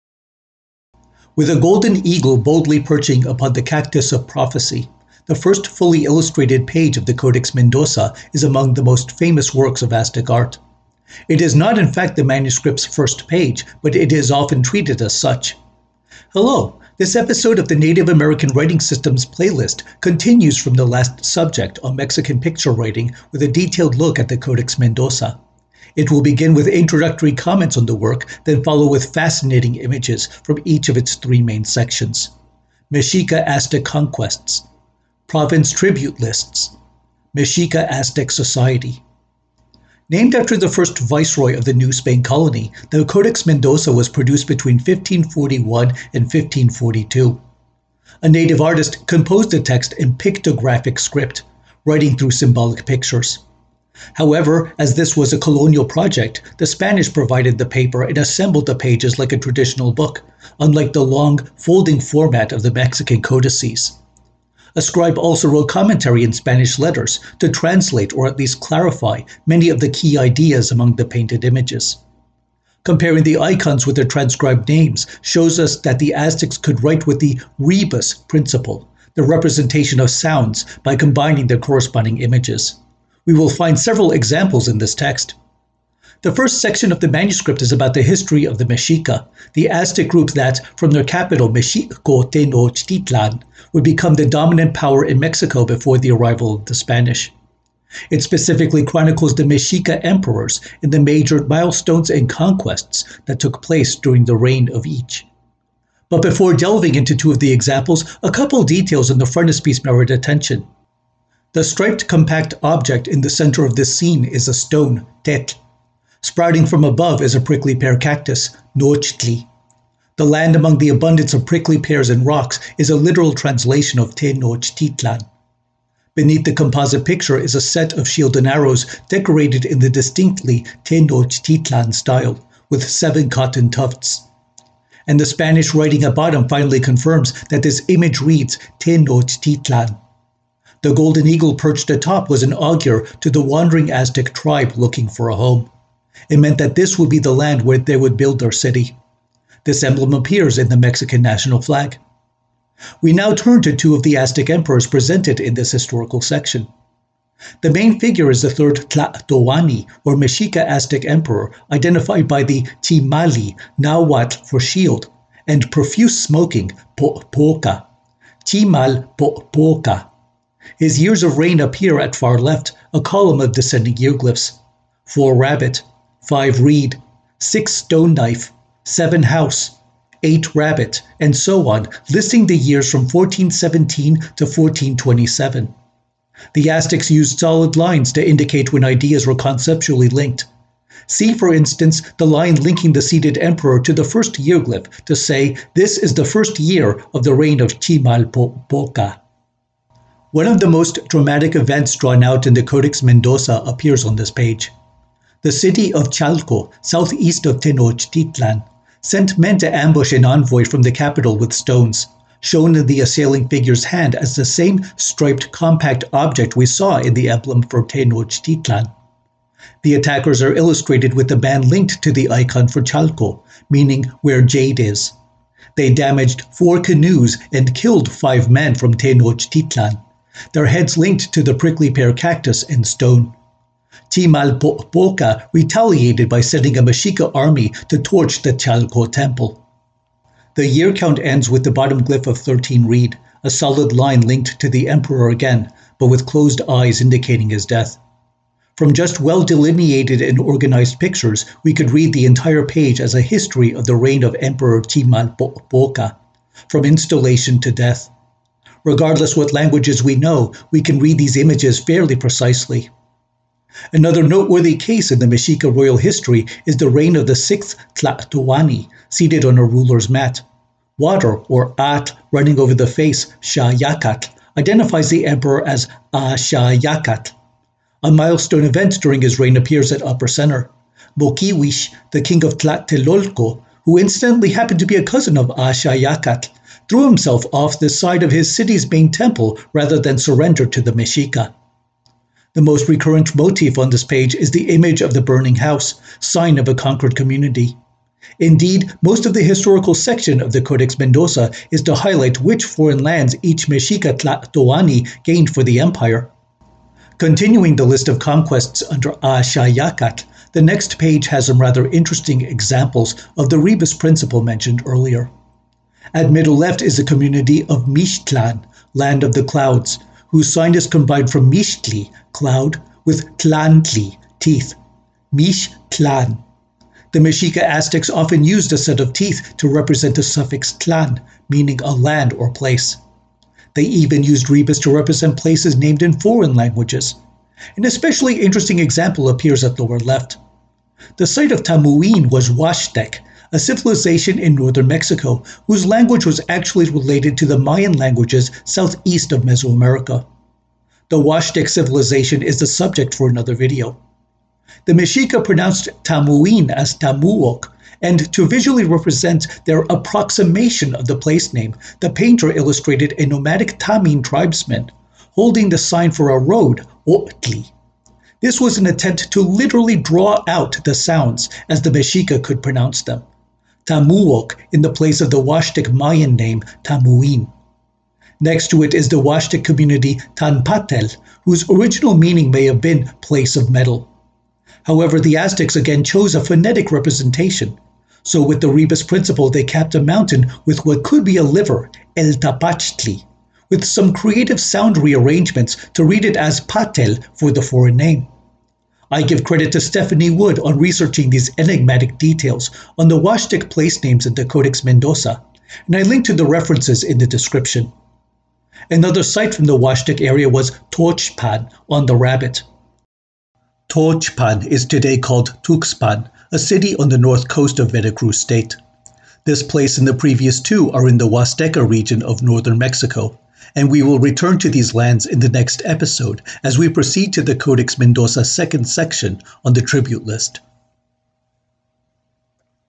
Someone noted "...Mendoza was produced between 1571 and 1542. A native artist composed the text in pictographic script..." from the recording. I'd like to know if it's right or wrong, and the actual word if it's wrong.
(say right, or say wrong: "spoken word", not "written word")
wrong: "1541", not "1571".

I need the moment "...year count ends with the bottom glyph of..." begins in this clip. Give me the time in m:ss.
4:00.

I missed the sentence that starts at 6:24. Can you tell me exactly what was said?
However, the Aztecs again chose a phonetic representation.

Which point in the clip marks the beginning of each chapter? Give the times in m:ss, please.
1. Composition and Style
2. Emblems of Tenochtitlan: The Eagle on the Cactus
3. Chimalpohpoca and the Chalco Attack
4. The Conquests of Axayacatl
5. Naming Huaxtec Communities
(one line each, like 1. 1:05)
1. 0:39
2. 1:24
3. 2:32
4. 4:23
5. 5:33.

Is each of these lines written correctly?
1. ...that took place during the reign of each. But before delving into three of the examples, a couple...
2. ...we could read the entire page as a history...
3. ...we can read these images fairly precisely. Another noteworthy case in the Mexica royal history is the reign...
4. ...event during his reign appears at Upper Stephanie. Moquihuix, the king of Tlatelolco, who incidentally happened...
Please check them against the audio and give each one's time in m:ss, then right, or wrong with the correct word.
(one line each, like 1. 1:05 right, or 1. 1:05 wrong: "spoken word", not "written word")
1. 1:43 wrong: "two", not "three"
2. 4:11 right
3. 4:20 right
4. 4:38 wrong: "Center", not "Stephanie".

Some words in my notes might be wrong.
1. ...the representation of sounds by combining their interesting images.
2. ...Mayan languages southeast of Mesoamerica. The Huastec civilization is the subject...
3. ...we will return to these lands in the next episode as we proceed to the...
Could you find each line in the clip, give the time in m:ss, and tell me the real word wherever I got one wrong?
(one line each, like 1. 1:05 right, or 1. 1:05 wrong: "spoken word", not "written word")
1. 1:19 wrong: "corresponding", not "interesting"
2. 5:47 right
3. 7:03 right.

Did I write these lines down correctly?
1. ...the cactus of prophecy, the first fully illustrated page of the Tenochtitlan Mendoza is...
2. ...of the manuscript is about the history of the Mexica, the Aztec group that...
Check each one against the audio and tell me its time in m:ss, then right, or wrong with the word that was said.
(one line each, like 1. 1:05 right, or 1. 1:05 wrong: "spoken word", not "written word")
1. 0:03 wrong: "Codex", not "Tenochtitlan"
2. 1:26 right.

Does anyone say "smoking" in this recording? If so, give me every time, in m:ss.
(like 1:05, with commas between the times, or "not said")
2:46.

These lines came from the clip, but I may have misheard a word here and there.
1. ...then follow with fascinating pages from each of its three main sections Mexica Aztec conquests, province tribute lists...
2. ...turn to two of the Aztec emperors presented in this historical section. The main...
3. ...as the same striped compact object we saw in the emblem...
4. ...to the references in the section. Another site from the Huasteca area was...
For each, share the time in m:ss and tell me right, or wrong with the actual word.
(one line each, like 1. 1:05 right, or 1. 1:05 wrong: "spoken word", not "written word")
1. 0:28 wrong: "images", not "pages"
2. 2:33 right
3. 3:34 right
4. 6:46 wrong: "description", not "section".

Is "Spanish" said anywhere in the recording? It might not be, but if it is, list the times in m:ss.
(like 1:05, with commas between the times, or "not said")
0:56, 1:06, 1:36, 2:15.